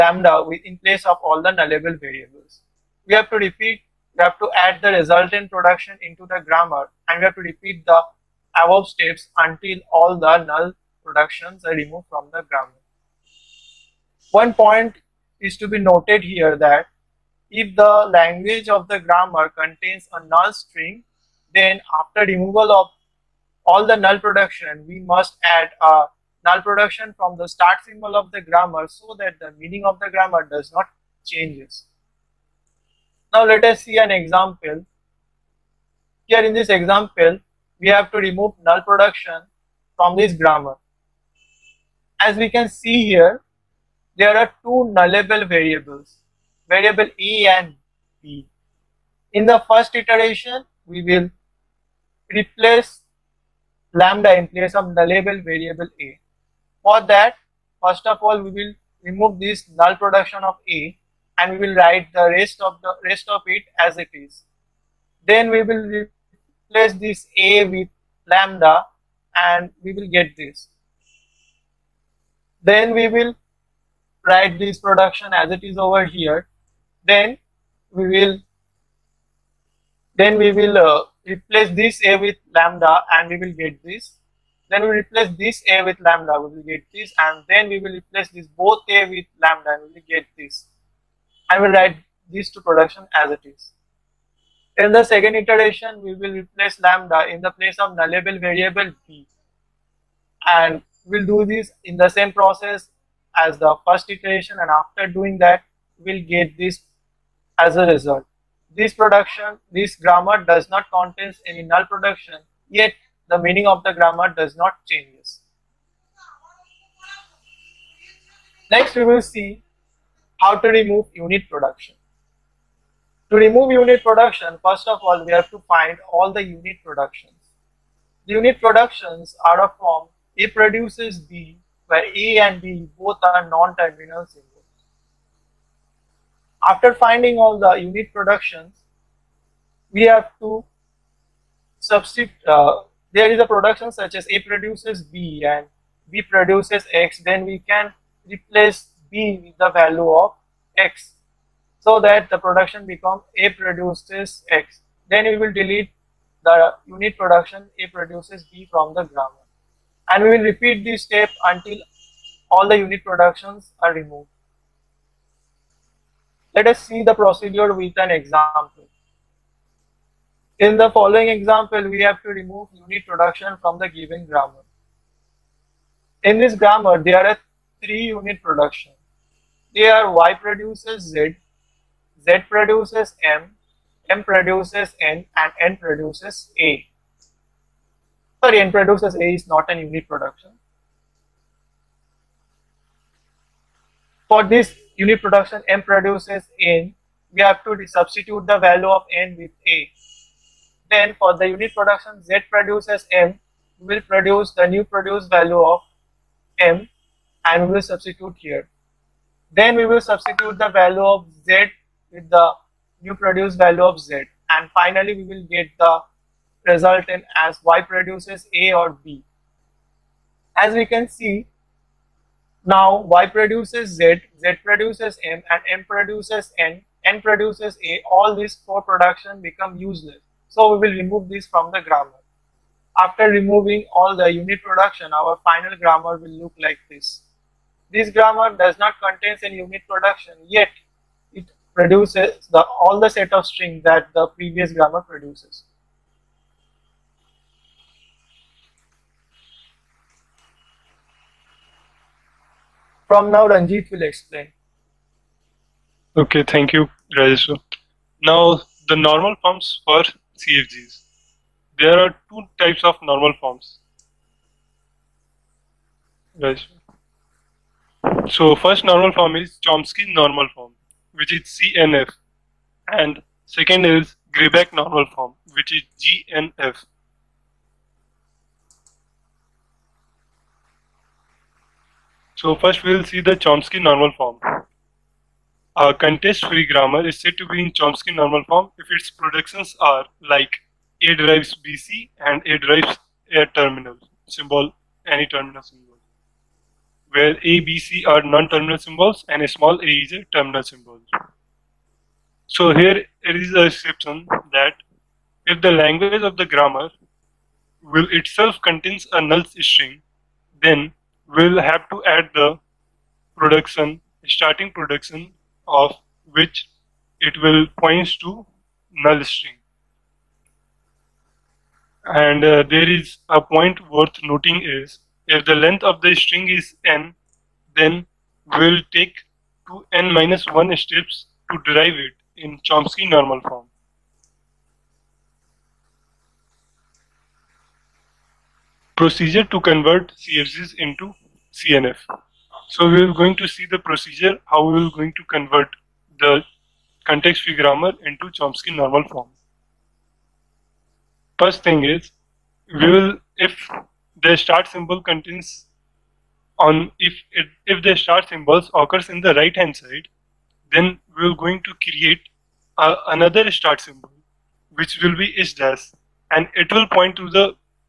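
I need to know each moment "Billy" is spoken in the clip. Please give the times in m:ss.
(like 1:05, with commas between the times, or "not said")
not said.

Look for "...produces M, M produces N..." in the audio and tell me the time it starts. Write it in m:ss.
3:02.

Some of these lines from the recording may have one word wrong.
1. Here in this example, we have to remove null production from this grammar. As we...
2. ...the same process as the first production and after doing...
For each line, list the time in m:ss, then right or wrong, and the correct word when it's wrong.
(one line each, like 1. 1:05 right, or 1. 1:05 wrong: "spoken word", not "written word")
1. 0:36 right
2. 1:41 wrong: "iteration", not "production".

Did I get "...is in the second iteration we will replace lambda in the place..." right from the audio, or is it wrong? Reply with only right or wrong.
right.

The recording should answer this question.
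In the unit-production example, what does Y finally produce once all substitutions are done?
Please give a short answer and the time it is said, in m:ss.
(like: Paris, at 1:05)
A or B, at 3:38.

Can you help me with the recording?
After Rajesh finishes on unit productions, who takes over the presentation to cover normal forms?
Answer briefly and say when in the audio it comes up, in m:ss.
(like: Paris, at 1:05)
Ranjit, at 4:13.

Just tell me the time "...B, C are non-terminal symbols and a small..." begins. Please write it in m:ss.
4:57.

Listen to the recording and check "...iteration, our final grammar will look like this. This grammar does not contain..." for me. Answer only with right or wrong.
wrong.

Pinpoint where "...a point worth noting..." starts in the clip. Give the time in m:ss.
5:23.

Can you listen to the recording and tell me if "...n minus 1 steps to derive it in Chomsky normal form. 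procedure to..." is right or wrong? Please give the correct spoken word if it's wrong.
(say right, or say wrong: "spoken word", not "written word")
right.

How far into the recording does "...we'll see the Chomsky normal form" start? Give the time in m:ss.
4:42.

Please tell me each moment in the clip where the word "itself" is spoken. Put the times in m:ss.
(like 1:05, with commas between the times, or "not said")
5:08.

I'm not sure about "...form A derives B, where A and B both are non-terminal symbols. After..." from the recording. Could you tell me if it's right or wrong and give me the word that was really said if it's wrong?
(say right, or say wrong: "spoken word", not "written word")
wrong: "produces", not "derives".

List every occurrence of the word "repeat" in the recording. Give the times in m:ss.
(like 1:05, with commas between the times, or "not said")
0:03, 0:07, 2:40.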